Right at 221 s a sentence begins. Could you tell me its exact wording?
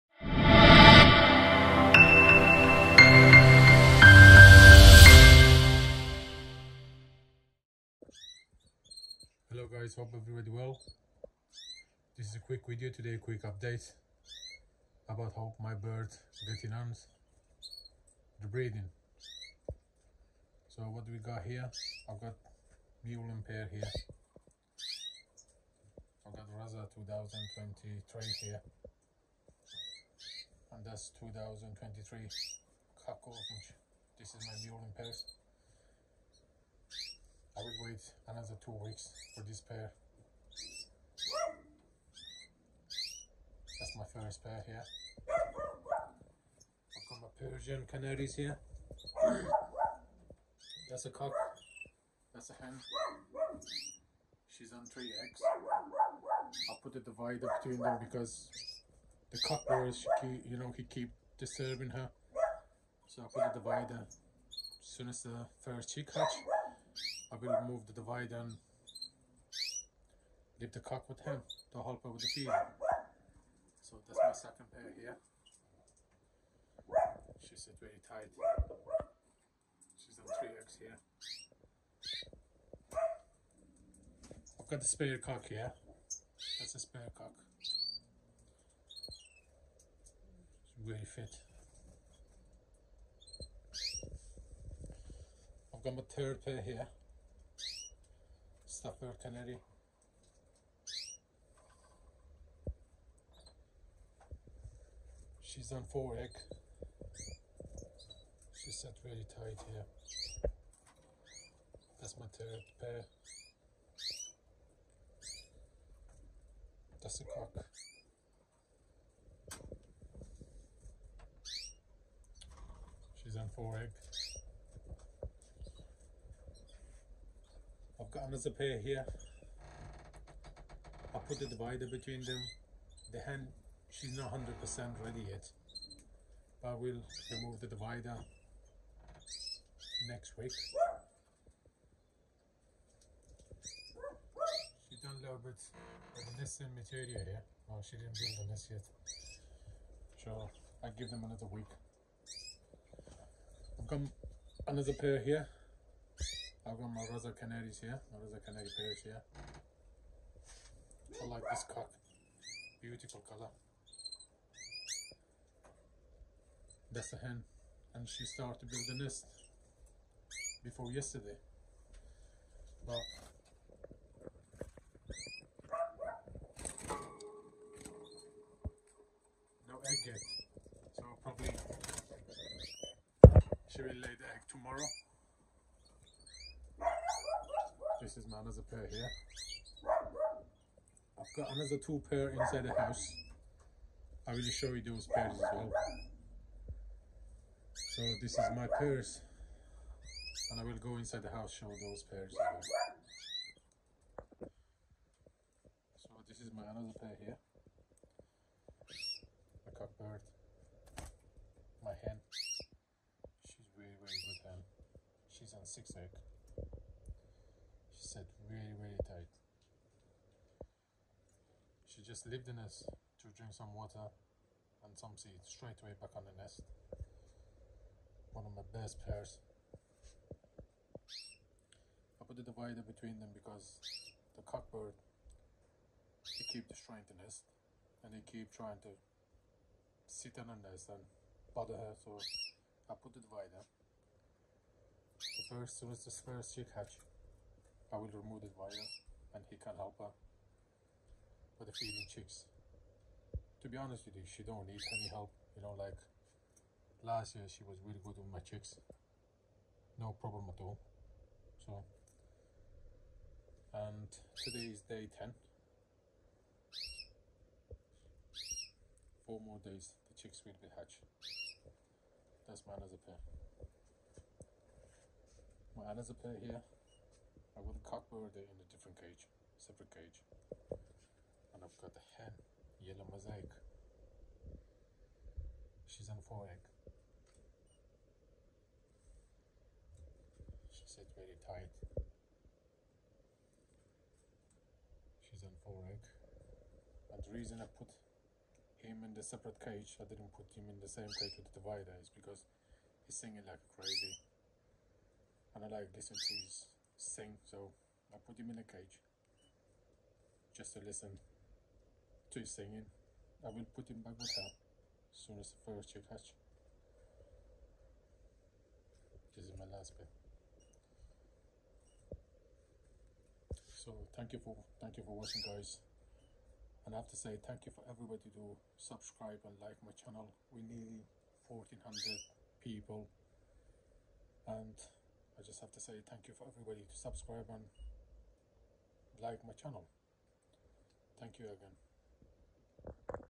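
She just lived the nest to drink some water and some seeds straight away back on the nest.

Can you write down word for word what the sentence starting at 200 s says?
And I will go inside the house show those pairs as well.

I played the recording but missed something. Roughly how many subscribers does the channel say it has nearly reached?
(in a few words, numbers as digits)
1400.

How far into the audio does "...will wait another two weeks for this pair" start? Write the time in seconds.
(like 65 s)
37 s.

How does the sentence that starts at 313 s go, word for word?
I will put him back with as soon as the first chick hatch.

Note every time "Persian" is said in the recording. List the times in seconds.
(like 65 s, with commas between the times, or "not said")
47 s.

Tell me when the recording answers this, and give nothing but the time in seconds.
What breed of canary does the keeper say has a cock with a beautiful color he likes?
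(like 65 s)
157 s.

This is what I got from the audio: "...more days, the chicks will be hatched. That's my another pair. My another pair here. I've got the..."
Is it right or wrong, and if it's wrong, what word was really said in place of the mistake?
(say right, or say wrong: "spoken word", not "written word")
right.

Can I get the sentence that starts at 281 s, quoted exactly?
And I've got the hen, yellow mosaic.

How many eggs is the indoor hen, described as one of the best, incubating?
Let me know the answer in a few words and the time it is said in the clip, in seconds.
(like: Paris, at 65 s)
6, at 215 s.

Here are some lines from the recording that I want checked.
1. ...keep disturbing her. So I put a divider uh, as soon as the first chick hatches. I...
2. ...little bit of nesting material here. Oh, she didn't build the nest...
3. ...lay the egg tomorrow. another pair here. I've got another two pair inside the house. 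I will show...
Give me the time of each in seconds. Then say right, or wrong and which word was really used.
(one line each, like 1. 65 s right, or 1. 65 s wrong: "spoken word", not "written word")
1. 60 s right
2. 145 s right
3. 183 s right.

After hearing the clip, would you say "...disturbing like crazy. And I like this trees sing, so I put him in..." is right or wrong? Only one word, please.
wrong.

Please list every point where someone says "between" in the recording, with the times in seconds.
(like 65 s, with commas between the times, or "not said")
57 s, 131 s, 232 s.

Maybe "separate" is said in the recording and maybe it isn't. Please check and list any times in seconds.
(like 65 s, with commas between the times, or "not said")
279 s, 299 s.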